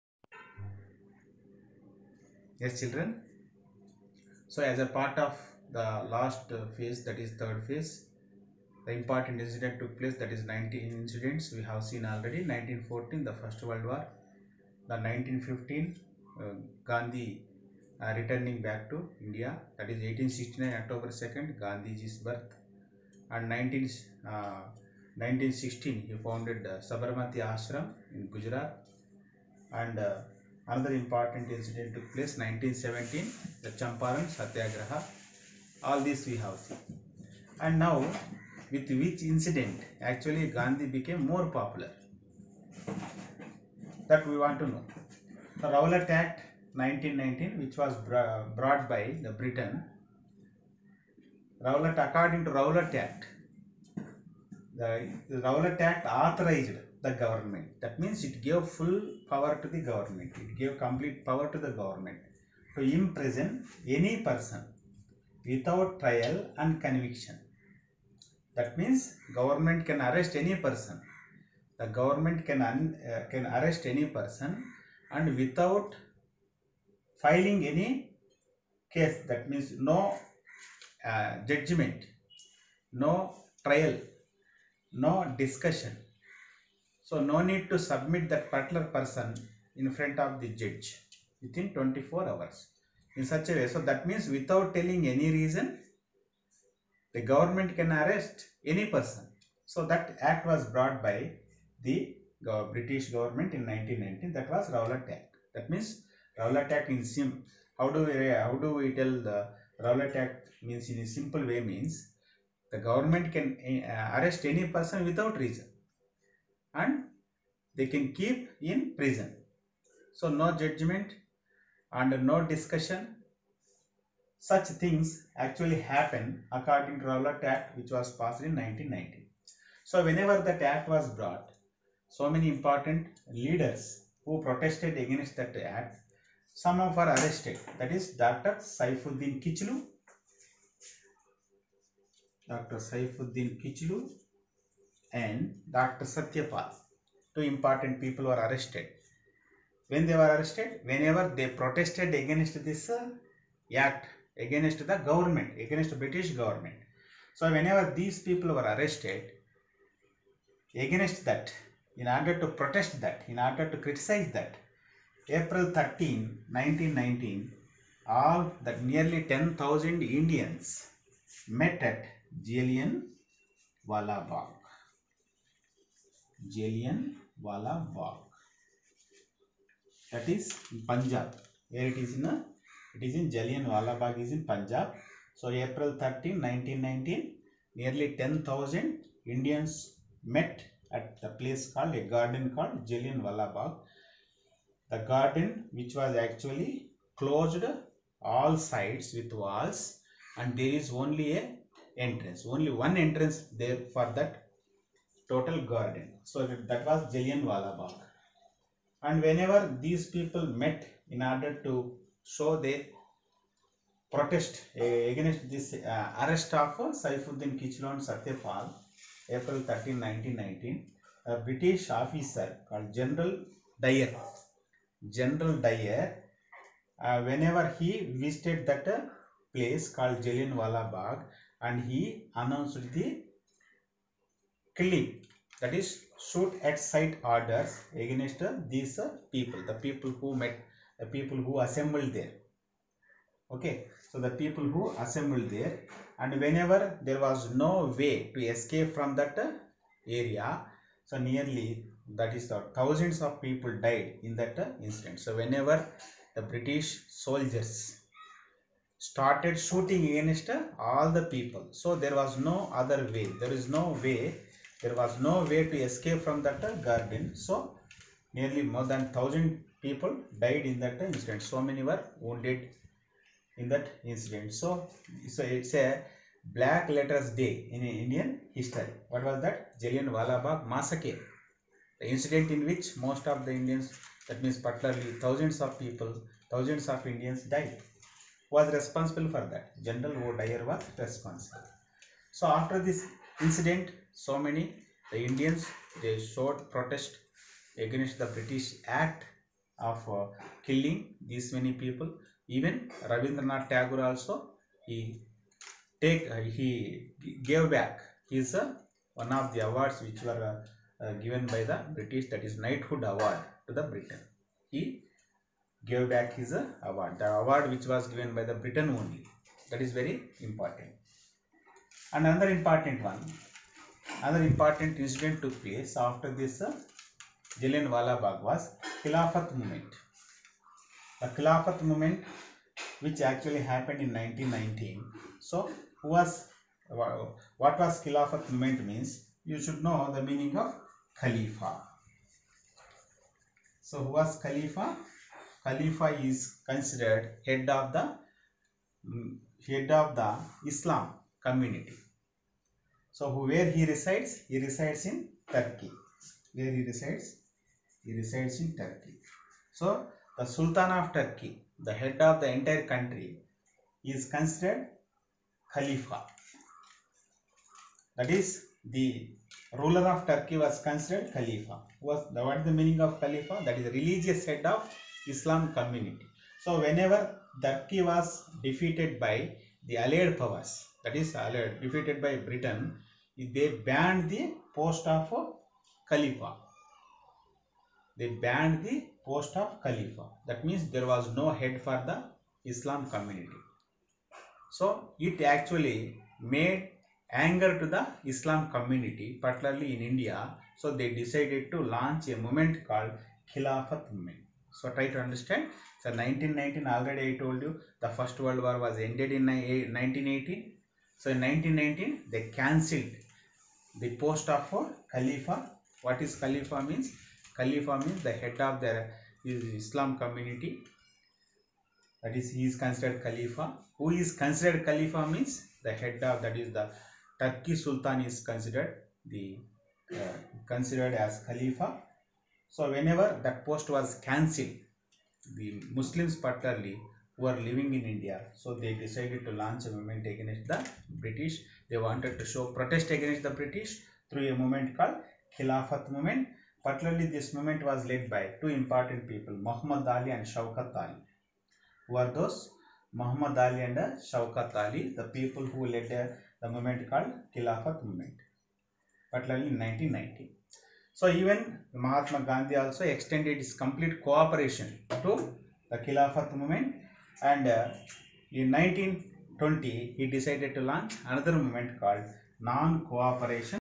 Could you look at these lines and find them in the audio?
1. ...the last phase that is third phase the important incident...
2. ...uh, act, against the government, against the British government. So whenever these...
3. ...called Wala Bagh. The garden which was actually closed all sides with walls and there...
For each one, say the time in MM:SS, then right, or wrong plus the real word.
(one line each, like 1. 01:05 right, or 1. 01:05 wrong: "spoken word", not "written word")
1. 00:05 right
2. 02:32 right
3. 03:12 right.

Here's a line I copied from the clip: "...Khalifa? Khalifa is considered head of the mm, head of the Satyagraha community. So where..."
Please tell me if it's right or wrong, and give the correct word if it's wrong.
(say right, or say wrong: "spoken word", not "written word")
wrong: "Islam", not "Satyagraha".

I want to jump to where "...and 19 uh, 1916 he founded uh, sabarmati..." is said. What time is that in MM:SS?
00:23.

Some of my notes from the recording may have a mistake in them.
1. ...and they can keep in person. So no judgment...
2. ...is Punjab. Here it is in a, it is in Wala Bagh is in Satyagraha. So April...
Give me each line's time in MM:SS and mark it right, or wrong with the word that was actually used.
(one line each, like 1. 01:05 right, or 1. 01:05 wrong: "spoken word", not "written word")
1. 01:56 wrong: "prison", not "person"
2. 03:00 wrong: "Punjab", not "Satyagraha".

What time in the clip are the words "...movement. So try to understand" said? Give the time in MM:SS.
06:44.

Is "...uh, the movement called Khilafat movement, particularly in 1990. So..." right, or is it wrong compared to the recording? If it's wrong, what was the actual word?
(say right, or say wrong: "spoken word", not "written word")
right.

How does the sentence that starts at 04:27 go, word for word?
So nearly more than 1000 people died in that incident.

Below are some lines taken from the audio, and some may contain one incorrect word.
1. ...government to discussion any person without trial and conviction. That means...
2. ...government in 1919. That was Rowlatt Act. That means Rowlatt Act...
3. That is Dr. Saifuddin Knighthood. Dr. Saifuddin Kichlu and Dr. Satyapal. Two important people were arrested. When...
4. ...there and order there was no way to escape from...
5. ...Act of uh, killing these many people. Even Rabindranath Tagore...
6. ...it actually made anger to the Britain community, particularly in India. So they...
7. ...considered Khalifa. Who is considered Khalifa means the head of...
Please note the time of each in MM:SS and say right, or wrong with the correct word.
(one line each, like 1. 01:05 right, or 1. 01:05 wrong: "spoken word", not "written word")
1. 01:01 wrong: "imprison", not "discussion"
2. 01:43 right
3. 02:17 wrong: "Kichlu", not "Knighthood"
4. 04:05 wrong: "whenever", not "order"
5. 04:58 right
6. 06:35 wrong: "Islam", not "Britain"
7. 07:02 right.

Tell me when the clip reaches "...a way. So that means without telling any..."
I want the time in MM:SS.
01:33.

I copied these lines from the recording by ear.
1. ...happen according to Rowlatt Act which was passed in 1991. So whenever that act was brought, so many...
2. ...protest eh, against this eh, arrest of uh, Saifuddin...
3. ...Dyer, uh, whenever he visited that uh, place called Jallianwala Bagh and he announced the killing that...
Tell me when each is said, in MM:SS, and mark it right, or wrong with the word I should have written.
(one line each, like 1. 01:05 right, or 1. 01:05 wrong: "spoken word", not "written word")
1. 02:05 wrong: "1990", not "1991"
2. 03:34 right
3. 03:45 right.